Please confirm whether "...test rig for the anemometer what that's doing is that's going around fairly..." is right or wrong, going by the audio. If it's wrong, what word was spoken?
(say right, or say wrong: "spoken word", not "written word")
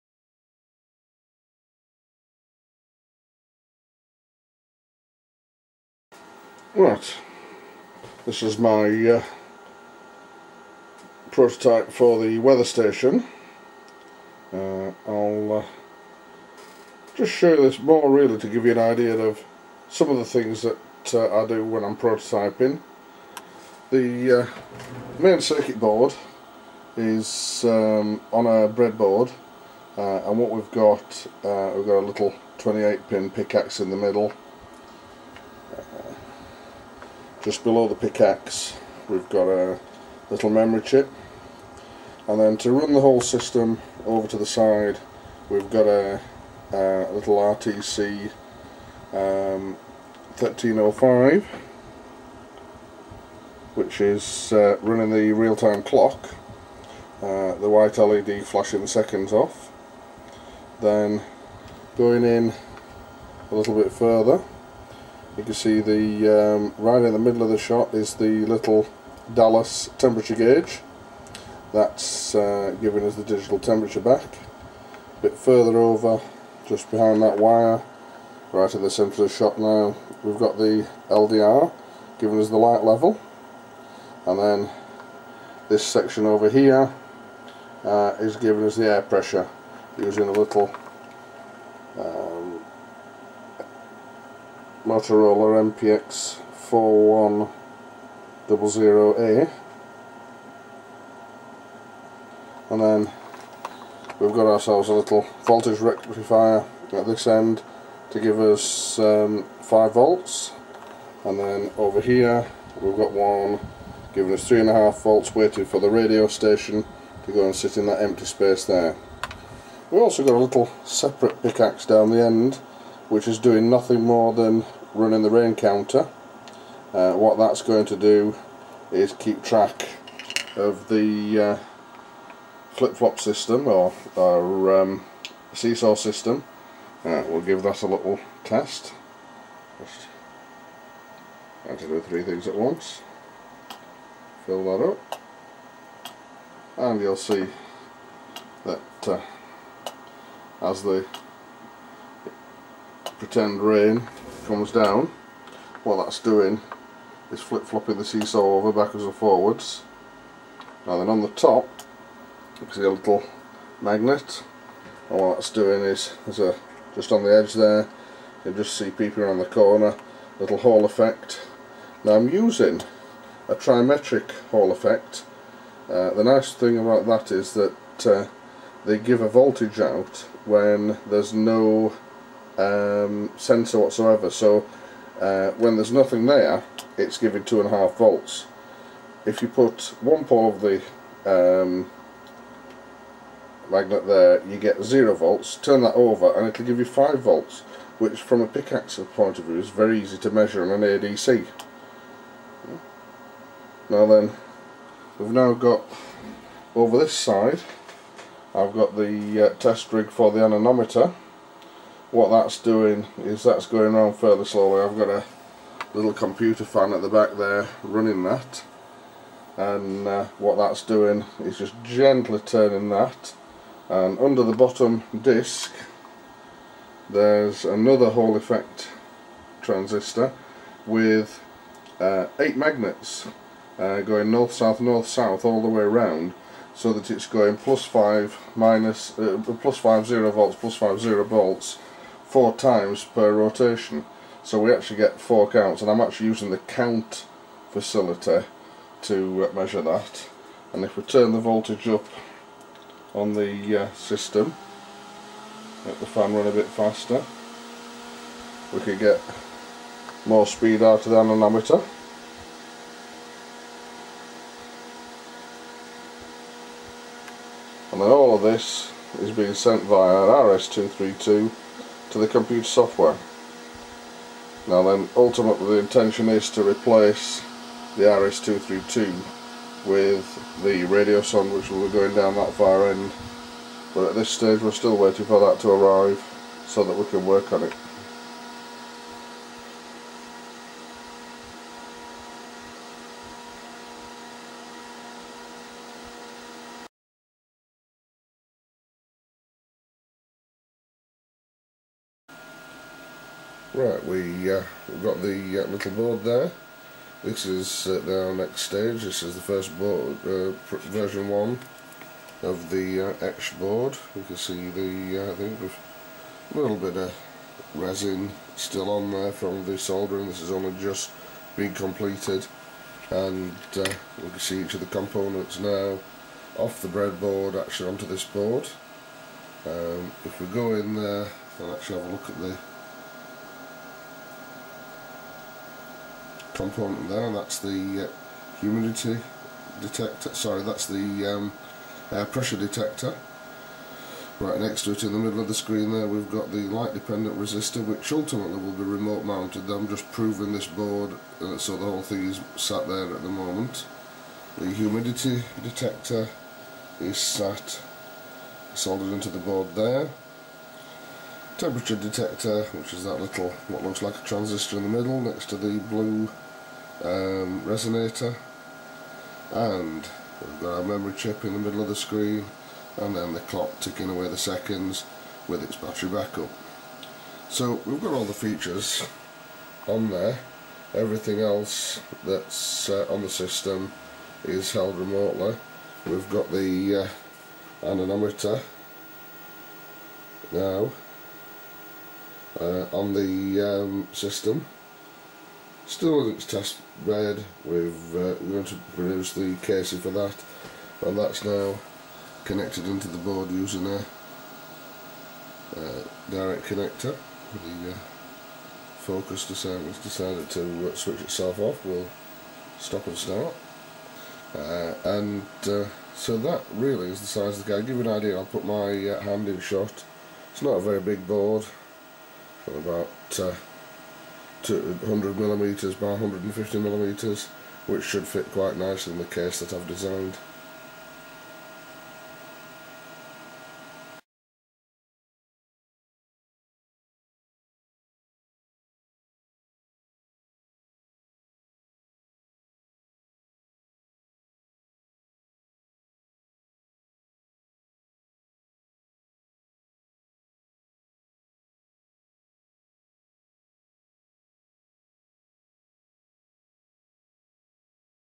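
right.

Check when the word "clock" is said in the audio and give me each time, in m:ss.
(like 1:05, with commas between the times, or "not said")
0:55, 6:13.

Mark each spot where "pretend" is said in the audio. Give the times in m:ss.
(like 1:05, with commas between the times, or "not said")
2:33.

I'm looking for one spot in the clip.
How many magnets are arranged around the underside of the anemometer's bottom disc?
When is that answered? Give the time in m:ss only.
3:52.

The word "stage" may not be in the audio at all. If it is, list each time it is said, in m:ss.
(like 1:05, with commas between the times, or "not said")
4:44, 5:08.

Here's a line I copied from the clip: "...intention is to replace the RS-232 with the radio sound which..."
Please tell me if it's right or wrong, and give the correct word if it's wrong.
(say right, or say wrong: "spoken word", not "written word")
right.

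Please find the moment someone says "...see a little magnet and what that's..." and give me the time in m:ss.
2:42.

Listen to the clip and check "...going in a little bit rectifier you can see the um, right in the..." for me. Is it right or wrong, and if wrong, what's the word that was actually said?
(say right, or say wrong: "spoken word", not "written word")
wrong: "further", not "rectifier".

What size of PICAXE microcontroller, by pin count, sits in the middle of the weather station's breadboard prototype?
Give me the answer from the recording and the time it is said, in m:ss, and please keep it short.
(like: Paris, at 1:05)
28 pin, at 0:32.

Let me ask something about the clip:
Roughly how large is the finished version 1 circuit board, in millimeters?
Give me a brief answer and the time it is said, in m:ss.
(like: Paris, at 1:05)
200 by 150 millimeters, at 7:04.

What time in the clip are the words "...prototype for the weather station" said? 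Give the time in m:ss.
0:11.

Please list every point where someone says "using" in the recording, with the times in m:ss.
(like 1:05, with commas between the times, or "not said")
1:29, 2:52, 4:06, 6:43.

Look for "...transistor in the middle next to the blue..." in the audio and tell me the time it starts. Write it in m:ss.
6:04.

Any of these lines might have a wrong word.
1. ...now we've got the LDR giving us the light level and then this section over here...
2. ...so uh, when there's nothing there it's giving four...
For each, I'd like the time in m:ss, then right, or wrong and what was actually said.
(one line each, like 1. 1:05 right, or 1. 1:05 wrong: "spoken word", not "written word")
1. 1:19 right
2. 3:04 wrong: "two", not "four".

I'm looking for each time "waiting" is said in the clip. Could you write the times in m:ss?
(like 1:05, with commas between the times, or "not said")
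1:55, 4:44.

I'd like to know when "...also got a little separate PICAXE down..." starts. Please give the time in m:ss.
2:00.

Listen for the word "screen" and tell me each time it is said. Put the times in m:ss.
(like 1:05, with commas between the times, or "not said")
5:45, 6:11.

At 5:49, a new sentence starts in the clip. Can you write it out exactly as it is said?
I'm just proving this board uh, so the whole thing is sat there at the moment.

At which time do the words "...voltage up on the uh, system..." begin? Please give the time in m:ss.
4:11.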